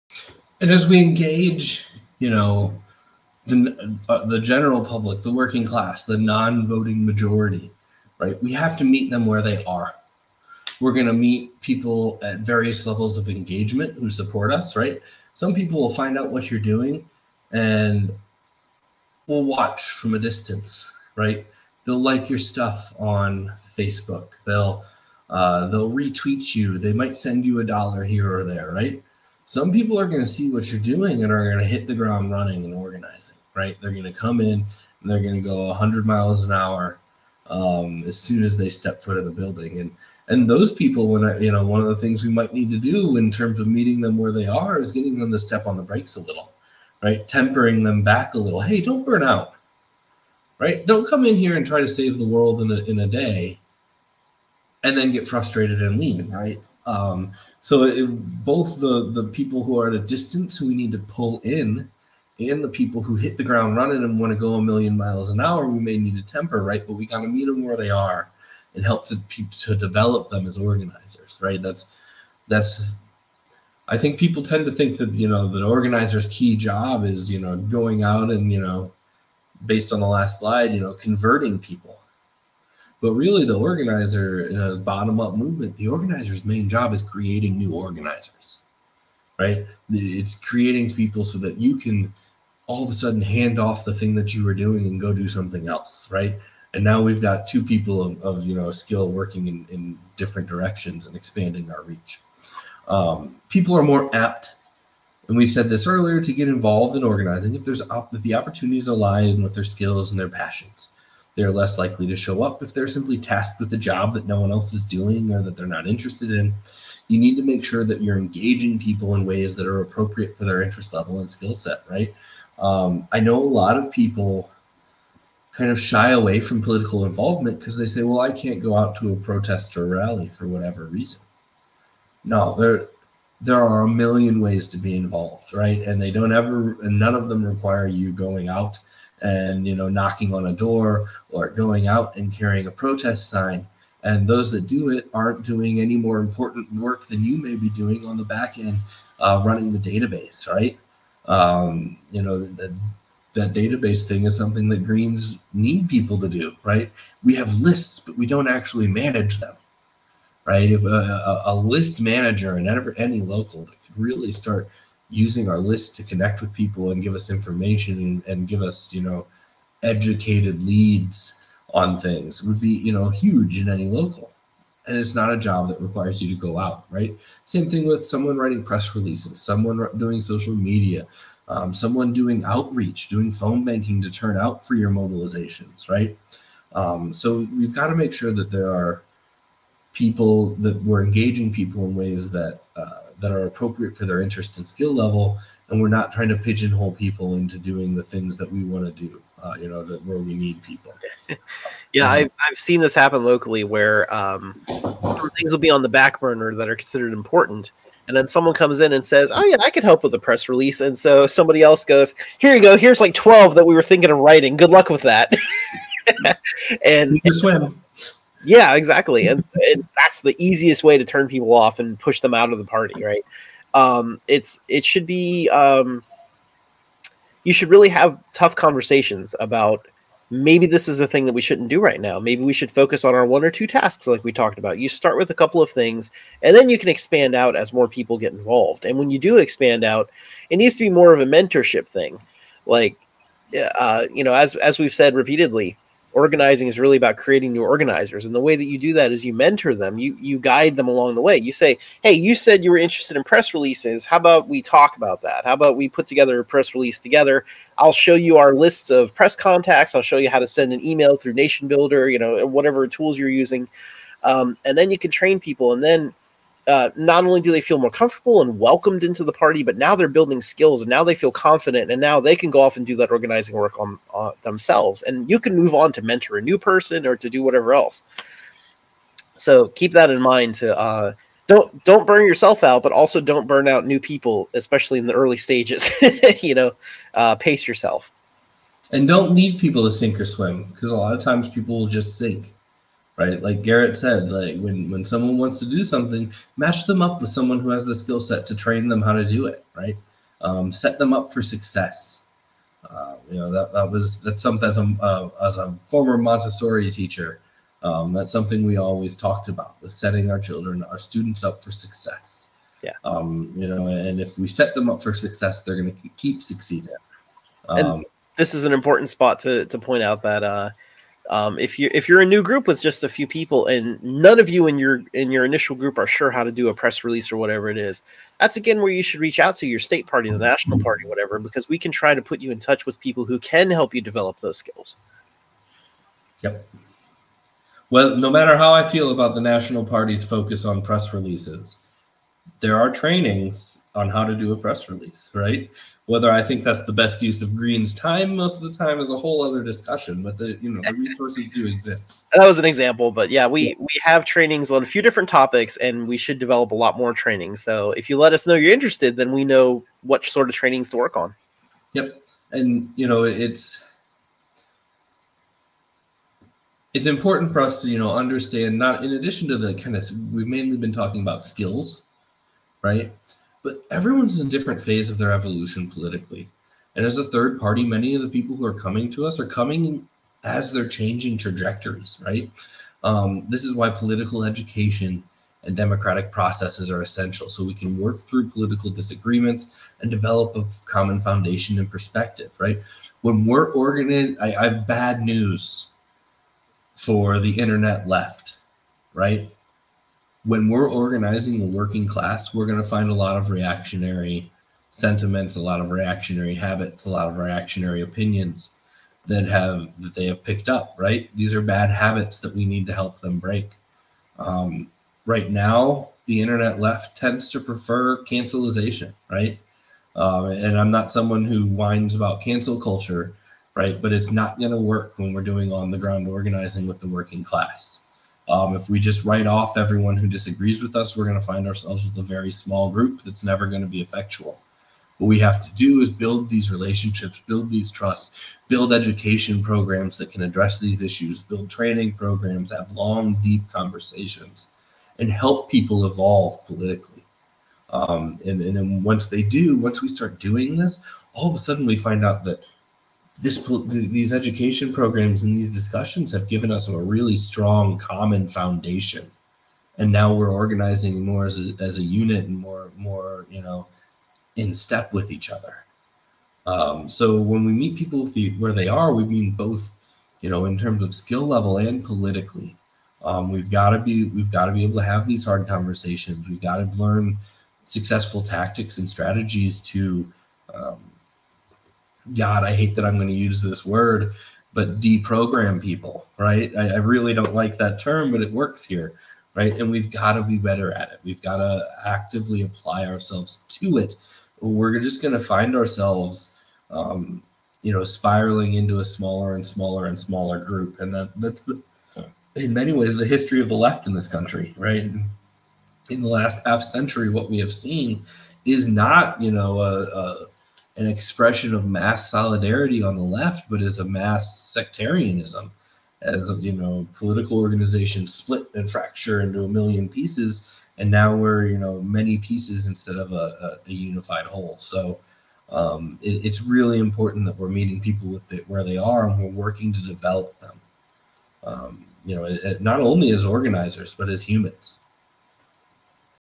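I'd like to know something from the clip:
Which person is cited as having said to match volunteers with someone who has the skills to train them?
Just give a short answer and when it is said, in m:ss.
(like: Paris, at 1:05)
Garrett, at 4:53.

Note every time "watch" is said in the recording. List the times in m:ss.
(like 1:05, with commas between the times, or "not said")
0:19.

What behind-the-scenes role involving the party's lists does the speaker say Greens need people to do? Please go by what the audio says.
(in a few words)
Running the database.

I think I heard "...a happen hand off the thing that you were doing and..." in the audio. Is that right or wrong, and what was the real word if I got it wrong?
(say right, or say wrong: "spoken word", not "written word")
wrong: "sudden", not "happen".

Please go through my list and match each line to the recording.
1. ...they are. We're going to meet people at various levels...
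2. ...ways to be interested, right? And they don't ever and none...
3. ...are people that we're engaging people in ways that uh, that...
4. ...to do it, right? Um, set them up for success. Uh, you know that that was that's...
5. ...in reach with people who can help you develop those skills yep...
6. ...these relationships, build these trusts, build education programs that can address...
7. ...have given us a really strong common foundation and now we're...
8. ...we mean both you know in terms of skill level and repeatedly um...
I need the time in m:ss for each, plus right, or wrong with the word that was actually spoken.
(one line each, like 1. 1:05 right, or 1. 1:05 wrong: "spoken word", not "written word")
1. 0:09 right
2. 2:14 wrong: "involved", not "interested"
3. 3:08 right
4. 4:59 right
5. 5:32 wrong: "touch", not "reach"
6. 7:16 right
7. 7:36 right
8. 7:49 wrong: "politically", not "repeatedly".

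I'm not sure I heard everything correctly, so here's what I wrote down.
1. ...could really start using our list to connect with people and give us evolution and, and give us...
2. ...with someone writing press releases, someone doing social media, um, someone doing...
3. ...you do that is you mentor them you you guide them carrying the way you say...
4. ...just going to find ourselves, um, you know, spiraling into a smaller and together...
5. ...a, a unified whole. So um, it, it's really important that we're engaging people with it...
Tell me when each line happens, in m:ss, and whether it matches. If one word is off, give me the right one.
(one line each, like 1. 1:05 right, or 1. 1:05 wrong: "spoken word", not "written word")
1. 2:43 wrong: "information", not "evolution"
2. 2:57 right
3. 4:08 wrong: "along", not "carrying"
4. 8:14 wrong: "smaller", not "together"
5. 8:43 wrong: "meeting", not "engaging".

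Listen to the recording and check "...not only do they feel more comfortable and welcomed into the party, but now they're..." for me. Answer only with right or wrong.
right.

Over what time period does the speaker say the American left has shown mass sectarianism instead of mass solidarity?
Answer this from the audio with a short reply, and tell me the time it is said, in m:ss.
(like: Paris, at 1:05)
The last half century, at 8:26.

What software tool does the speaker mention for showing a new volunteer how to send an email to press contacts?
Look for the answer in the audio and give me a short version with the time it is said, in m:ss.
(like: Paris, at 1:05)
NationBuilder, at 4:21.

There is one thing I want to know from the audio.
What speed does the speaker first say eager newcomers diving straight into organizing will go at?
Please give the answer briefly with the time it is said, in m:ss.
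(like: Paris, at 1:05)
100 miles an hour, at 0:35.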